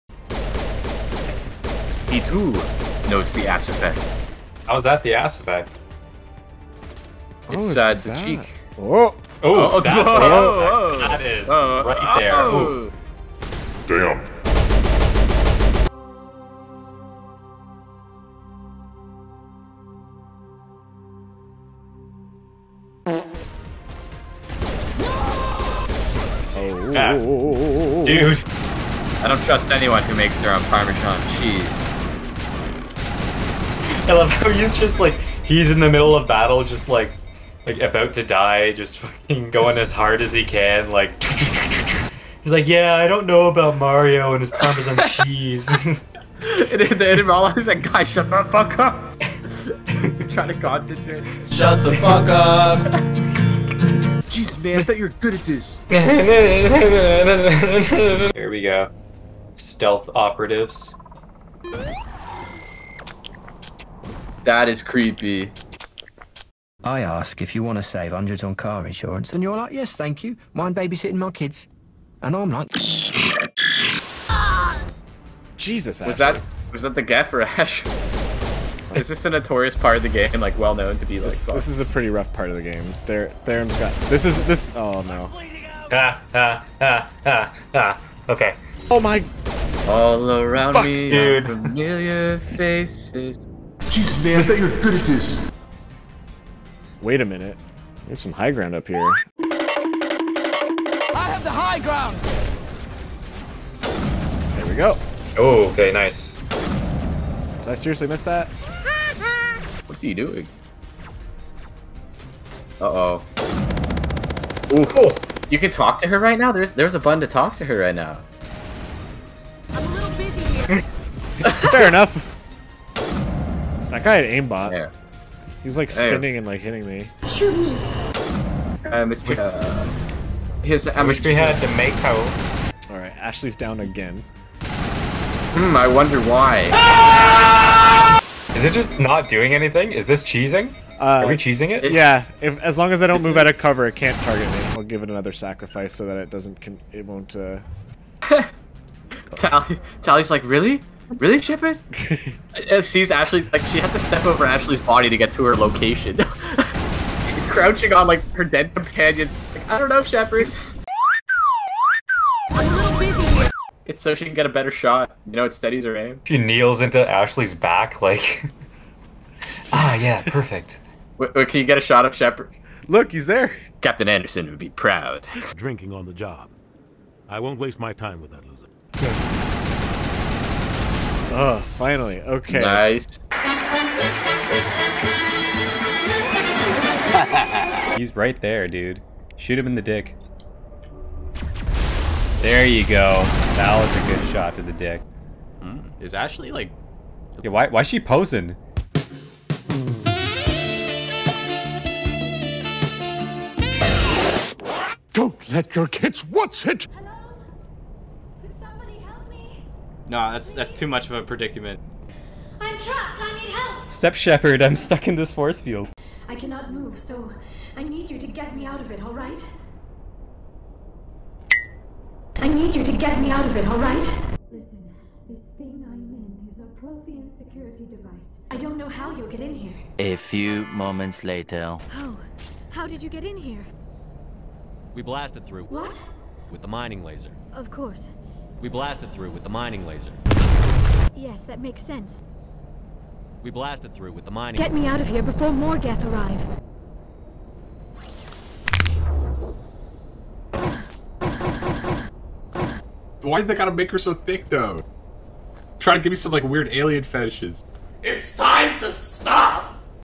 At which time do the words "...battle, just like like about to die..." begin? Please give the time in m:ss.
0:36.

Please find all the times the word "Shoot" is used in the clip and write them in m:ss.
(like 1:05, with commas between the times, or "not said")
2:07, 3:09.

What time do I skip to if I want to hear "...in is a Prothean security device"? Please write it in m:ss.
3:46.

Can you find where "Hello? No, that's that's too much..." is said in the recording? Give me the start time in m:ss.
3:26.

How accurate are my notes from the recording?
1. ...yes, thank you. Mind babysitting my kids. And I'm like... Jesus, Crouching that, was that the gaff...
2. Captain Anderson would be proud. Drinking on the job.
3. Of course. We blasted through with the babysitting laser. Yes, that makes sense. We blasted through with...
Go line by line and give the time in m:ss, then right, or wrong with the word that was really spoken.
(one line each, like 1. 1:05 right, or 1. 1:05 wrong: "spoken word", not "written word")
1. 1:09 wrong: "Was", not "Crouching"
2. 2:53 right
3. 3:57 wrong: "mining", not "babysitting".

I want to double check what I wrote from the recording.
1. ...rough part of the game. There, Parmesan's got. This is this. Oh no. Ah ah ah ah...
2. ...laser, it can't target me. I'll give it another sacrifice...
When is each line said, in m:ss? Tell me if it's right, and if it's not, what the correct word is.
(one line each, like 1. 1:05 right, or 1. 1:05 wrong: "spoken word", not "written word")
1. 1:22 wrong: "Theron", not "Parmesan"
2. 2:23 wrong: "cover", not "laser".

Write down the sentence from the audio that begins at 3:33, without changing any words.
Step Shepard, I'm stuck in this force field.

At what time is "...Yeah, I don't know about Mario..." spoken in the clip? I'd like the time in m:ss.
0:42.